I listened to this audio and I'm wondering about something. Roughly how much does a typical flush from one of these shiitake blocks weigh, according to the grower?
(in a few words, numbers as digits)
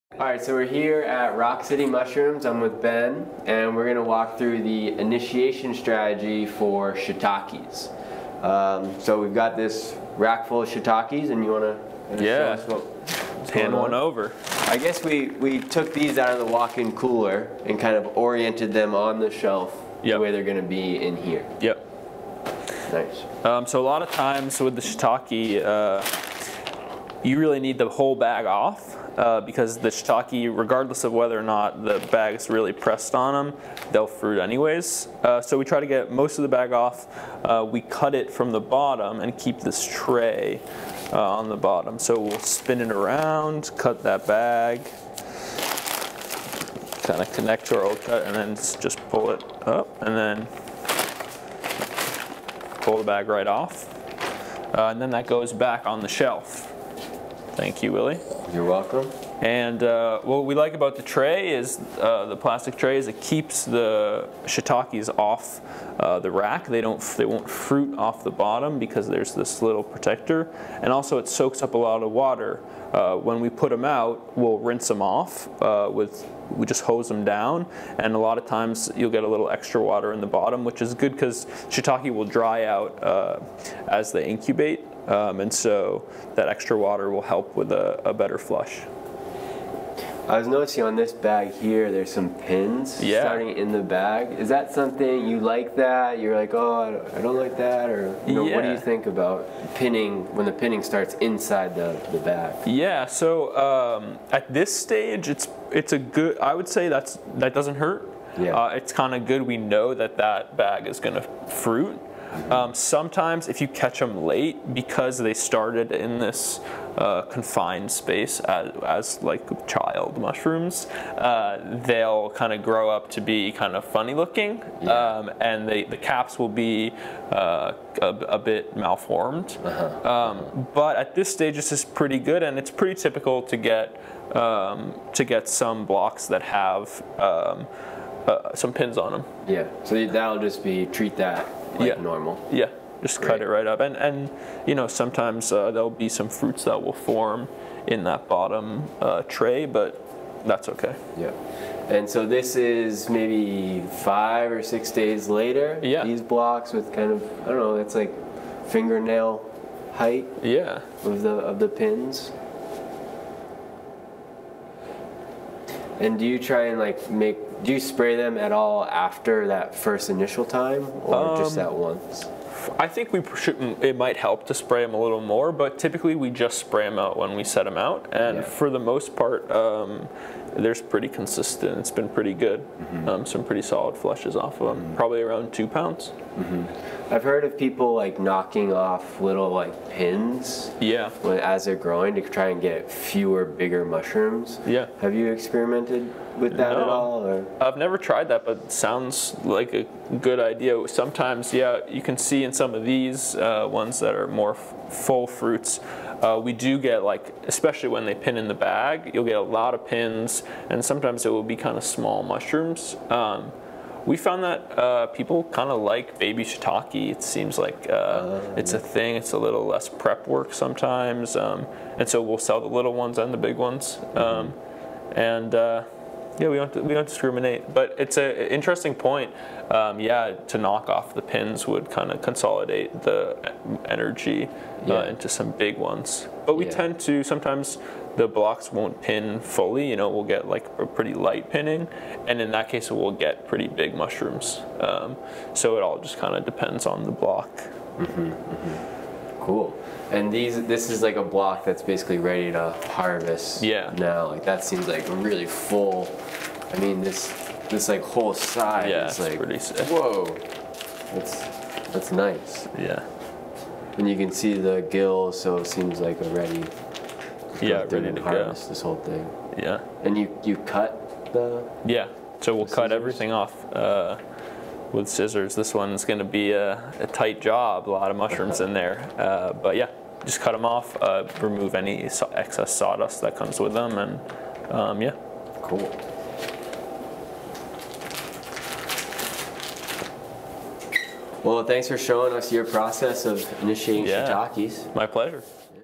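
2 pounds.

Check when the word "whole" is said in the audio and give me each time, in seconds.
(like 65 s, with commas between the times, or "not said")
27 s, 258 s, 268 s.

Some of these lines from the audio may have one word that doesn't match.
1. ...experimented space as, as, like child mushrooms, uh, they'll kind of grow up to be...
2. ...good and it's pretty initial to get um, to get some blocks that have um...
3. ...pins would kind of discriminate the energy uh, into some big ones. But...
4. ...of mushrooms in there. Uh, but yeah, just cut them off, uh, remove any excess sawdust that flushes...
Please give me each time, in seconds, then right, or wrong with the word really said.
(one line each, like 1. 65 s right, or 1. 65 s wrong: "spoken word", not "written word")
1. 117 s wrong: "confined", not "experimented"
2. 132 s wrong: "typical", not "initial"
3. 231 s wrong: "consolidate", not "discriminate"
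4. 278 s wrong: "comes", not "flushes".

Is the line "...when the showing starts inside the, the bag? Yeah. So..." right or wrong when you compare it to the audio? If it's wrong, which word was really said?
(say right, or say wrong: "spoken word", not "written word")
wrong: "pinning", not "showing".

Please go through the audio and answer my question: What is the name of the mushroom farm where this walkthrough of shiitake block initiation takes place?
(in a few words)
Rock City Mushrooms.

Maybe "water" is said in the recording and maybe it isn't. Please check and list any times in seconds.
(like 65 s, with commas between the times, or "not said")
72 s, 79 s, 86 s.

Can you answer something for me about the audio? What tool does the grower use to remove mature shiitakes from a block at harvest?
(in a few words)
Scissors.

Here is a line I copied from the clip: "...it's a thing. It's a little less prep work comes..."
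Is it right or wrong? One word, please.
wrong.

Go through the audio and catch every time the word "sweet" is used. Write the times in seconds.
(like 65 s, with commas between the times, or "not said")
not said.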